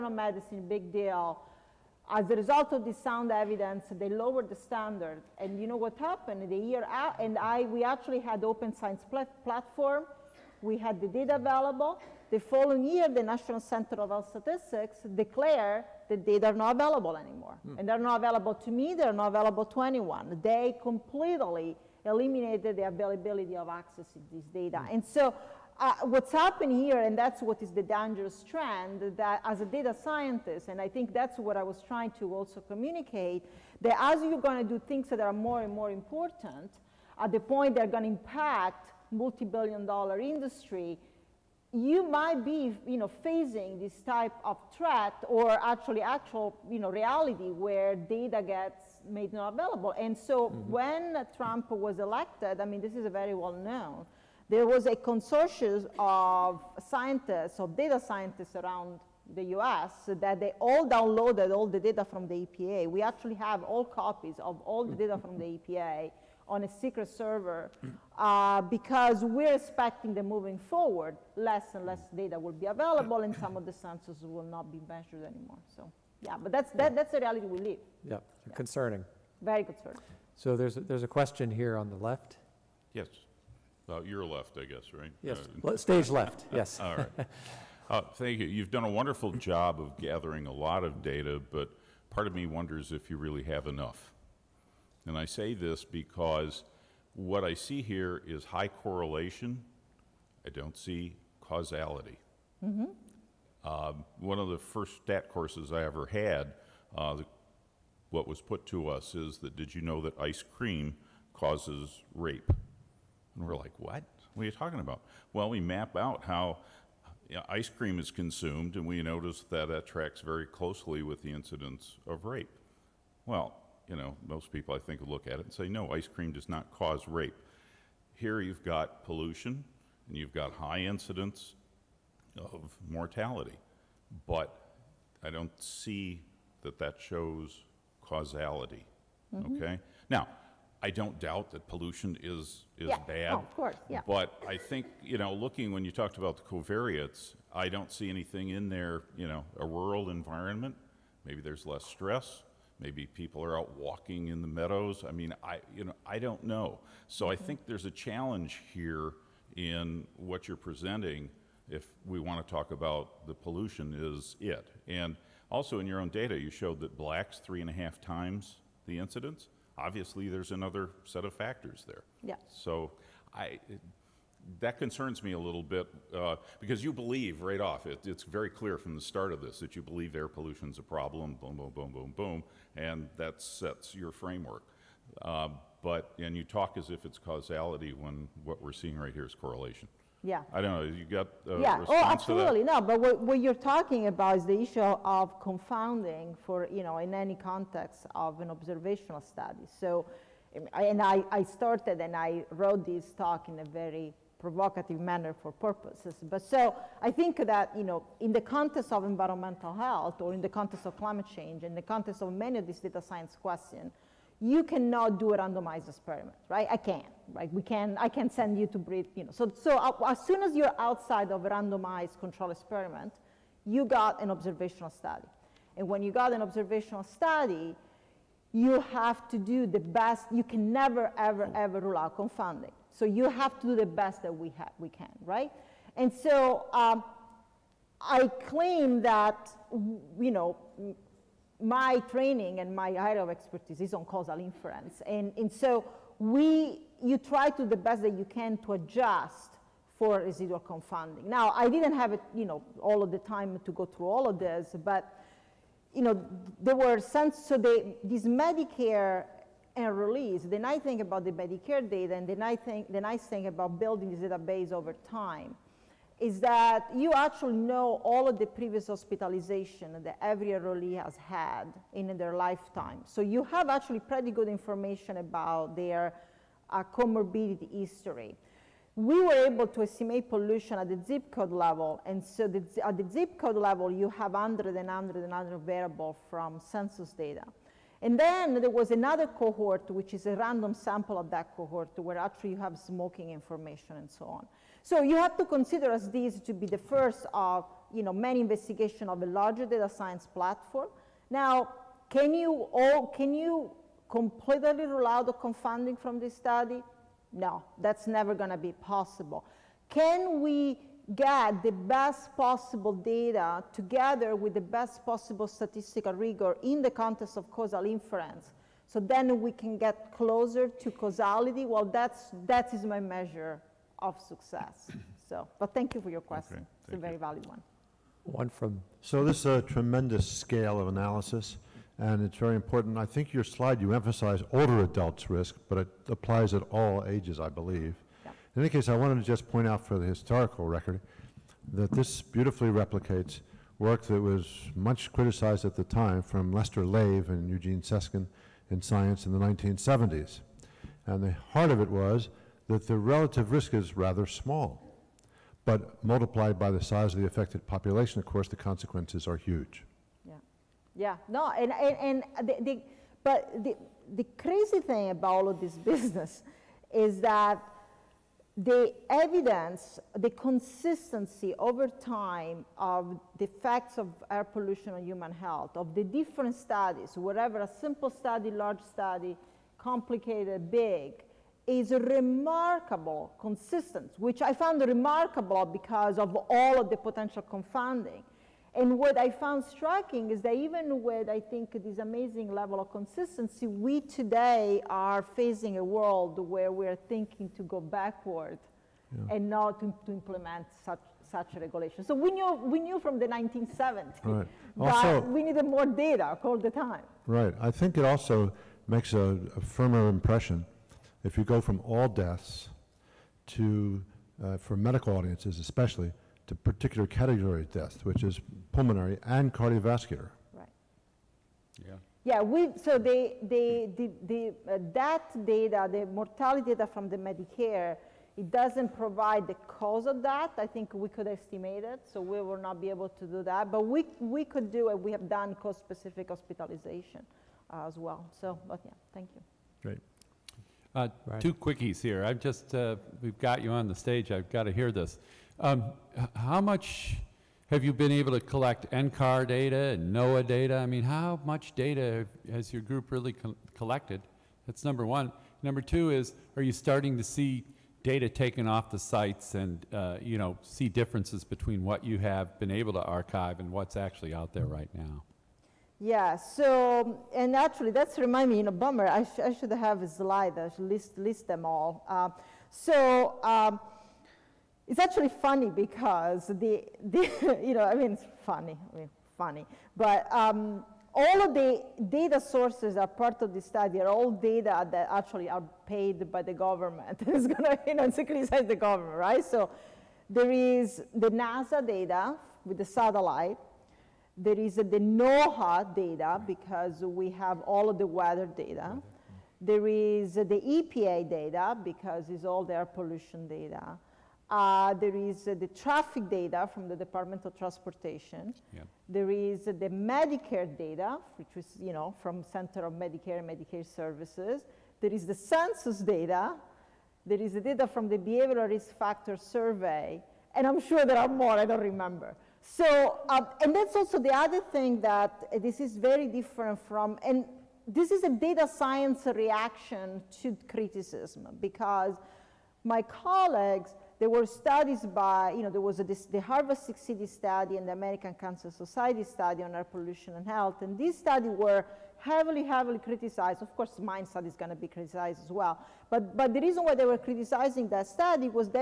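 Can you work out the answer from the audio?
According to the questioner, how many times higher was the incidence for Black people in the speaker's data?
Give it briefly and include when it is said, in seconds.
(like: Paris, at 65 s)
3.5, at 167 s.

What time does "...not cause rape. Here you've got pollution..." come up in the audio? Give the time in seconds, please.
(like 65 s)
126 s.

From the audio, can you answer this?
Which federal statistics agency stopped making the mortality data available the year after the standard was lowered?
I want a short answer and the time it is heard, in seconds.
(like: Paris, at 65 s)
National Center of Health Statistics, at 13 s.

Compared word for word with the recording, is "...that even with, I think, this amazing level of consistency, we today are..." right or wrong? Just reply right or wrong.
right.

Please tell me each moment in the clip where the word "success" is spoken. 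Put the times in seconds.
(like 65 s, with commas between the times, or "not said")
324 s.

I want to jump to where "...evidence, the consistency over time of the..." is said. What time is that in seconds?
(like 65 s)
369 s.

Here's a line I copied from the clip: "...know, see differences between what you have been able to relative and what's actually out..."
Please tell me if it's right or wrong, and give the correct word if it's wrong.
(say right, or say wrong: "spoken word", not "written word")
wrong: "archive", not "relative".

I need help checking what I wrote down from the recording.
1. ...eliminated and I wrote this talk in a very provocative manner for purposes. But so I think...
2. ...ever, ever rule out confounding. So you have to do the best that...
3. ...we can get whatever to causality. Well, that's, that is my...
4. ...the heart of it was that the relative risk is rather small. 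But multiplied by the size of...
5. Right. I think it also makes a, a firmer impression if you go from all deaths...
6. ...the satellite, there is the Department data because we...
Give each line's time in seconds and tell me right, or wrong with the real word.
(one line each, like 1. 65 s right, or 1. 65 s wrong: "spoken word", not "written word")
1. 201 s wrong: "started", not "eliminated"
2. 231 s right
3. 319 s wrong: "closer", not "whatever"
4. 351 s right
5. 407 s right
6. 492 s wrong: "NOAA", not "Department".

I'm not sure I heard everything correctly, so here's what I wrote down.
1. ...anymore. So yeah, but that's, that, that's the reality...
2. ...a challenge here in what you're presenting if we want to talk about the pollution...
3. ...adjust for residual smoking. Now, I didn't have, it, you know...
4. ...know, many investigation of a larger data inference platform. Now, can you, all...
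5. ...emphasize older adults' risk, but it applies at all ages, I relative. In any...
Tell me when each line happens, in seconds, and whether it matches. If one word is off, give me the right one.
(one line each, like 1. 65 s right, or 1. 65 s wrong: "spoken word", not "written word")
1. 75 s right
2. 157 s right
3. 248 s wrong: "confounding", not "smoking"
4. 298 s wrong: "science", not "inference"
5. 333 s wrong: "believe", not "relative".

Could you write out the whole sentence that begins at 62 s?
We actually have all copies of all the data from the EPA on a secret server mm.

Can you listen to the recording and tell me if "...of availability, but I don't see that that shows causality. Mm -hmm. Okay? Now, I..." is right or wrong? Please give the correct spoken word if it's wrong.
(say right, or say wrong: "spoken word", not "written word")
wrong: "mortality", not "availability".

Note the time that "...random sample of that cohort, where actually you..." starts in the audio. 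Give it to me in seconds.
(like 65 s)
290 s.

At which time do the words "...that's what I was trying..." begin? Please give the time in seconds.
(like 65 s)
31 s.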